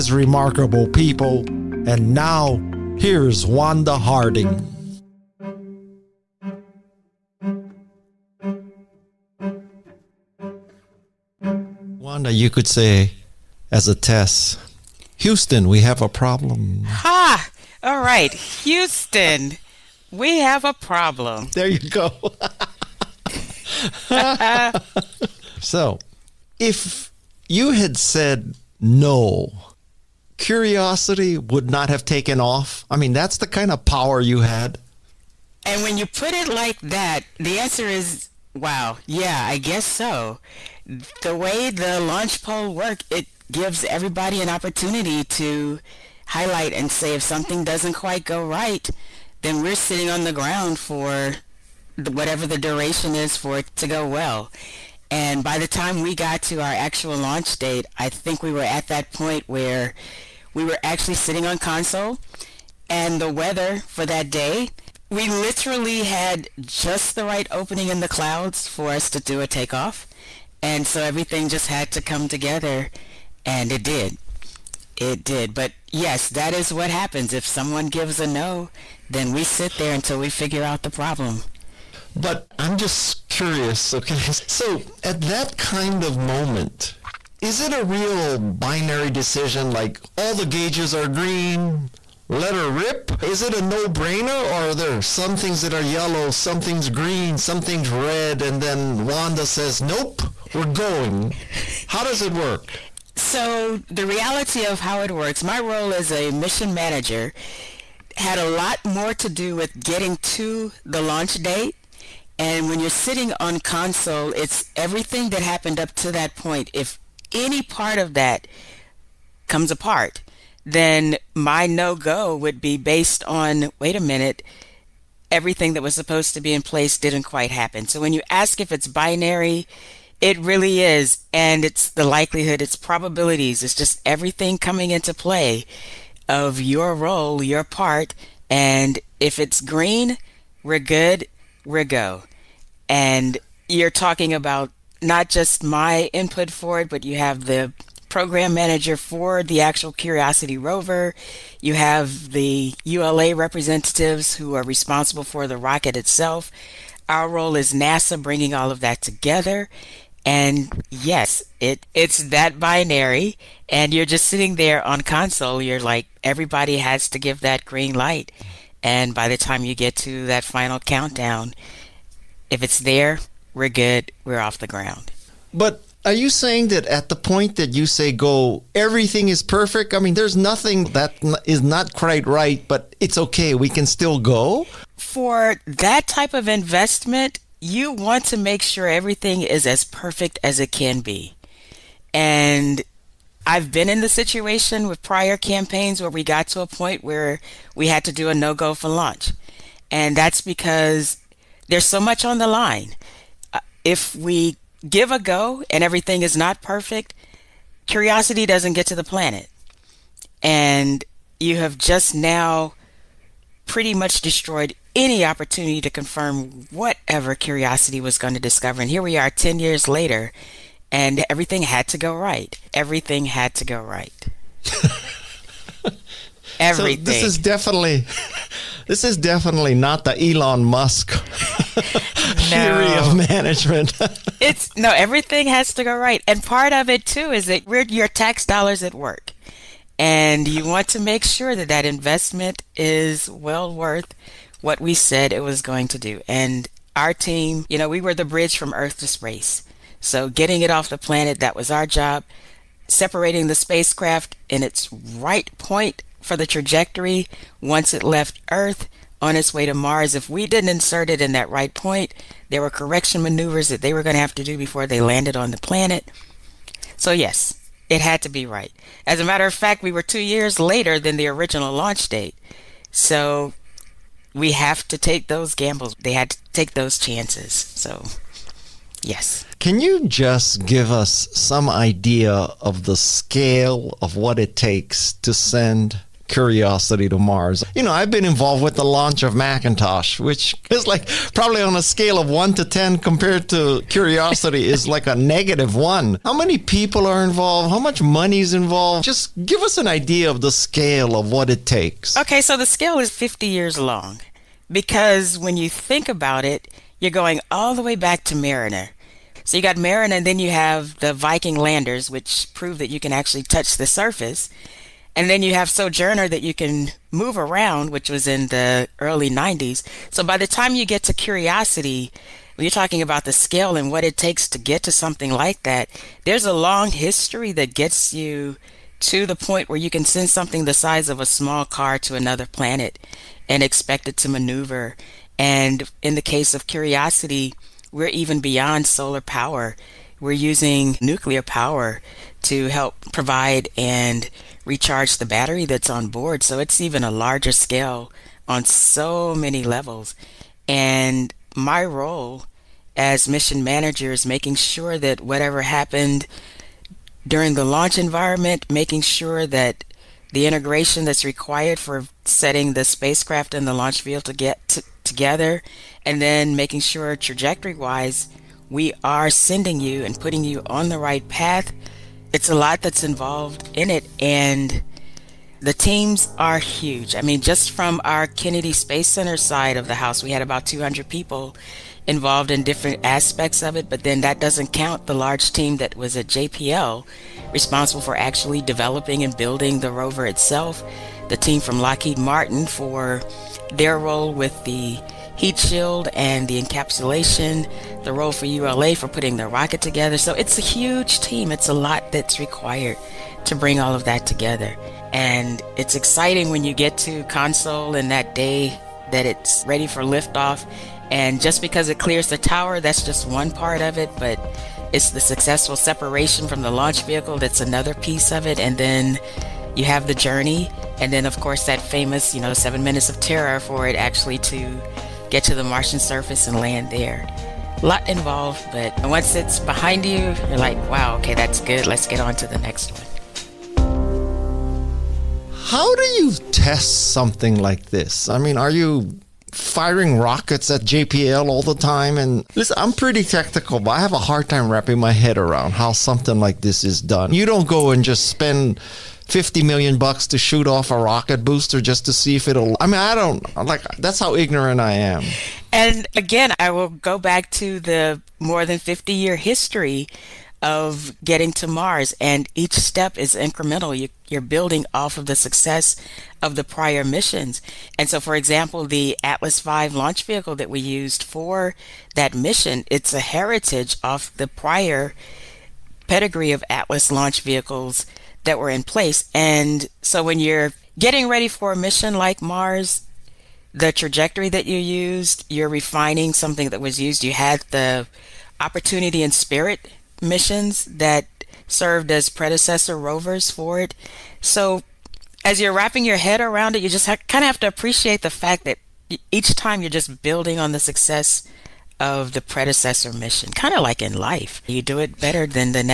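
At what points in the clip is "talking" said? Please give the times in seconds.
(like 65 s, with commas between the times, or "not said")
143 s, 322 s.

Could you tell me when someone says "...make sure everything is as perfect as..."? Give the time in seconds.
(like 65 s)
188 s.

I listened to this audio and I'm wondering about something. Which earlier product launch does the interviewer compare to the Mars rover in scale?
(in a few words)
Macintosh.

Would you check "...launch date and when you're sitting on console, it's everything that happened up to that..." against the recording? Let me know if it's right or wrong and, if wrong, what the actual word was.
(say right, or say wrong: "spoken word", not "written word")
right.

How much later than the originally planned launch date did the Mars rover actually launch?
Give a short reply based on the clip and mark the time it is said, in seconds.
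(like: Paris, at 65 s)
2 years, at 270 s.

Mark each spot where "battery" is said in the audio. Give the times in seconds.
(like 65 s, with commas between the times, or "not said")
345 s.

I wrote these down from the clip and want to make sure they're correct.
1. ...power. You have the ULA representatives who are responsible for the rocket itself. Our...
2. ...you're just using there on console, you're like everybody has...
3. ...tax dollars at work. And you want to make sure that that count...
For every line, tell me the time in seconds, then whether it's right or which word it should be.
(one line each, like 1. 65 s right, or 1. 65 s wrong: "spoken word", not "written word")
1. 150 s wrong: "rover", not "power"
2. 163 s wrong: "sitting", not "using"
3. 238 s wrong: "investment", not "count".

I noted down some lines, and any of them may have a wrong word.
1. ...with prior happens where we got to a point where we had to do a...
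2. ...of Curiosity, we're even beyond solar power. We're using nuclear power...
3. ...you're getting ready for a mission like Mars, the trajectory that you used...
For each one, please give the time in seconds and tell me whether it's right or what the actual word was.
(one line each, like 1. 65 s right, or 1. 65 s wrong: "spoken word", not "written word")
1. 194 s wrong: "campaigns", not "happens"
2. 336 s right
3. 480 s right.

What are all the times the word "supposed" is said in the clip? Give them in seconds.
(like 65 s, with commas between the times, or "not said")
125 s.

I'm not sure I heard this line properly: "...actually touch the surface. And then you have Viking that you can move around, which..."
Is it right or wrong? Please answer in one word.
wrong.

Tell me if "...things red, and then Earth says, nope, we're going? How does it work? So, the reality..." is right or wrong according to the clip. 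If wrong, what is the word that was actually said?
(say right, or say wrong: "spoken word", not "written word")
wrong: "Wanda", not "Earth".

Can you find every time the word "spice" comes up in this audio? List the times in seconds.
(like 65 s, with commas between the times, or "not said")
not said.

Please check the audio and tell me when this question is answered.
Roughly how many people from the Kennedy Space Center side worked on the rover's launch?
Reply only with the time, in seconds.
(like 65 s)
380 s.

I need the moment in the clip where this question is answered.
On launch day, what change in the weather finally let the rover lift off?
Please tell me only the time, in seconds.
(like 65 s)
67 s.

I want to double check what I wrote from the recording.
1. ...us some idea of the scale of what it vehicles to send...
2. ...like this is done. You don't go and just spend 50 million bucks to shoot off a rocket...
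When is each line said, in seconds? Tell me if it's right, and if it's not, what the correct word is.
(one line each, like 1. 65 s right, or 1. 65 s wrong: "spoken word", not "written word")
1. 280 s wrong: "takes", not "vehicles"
2. 446 s right.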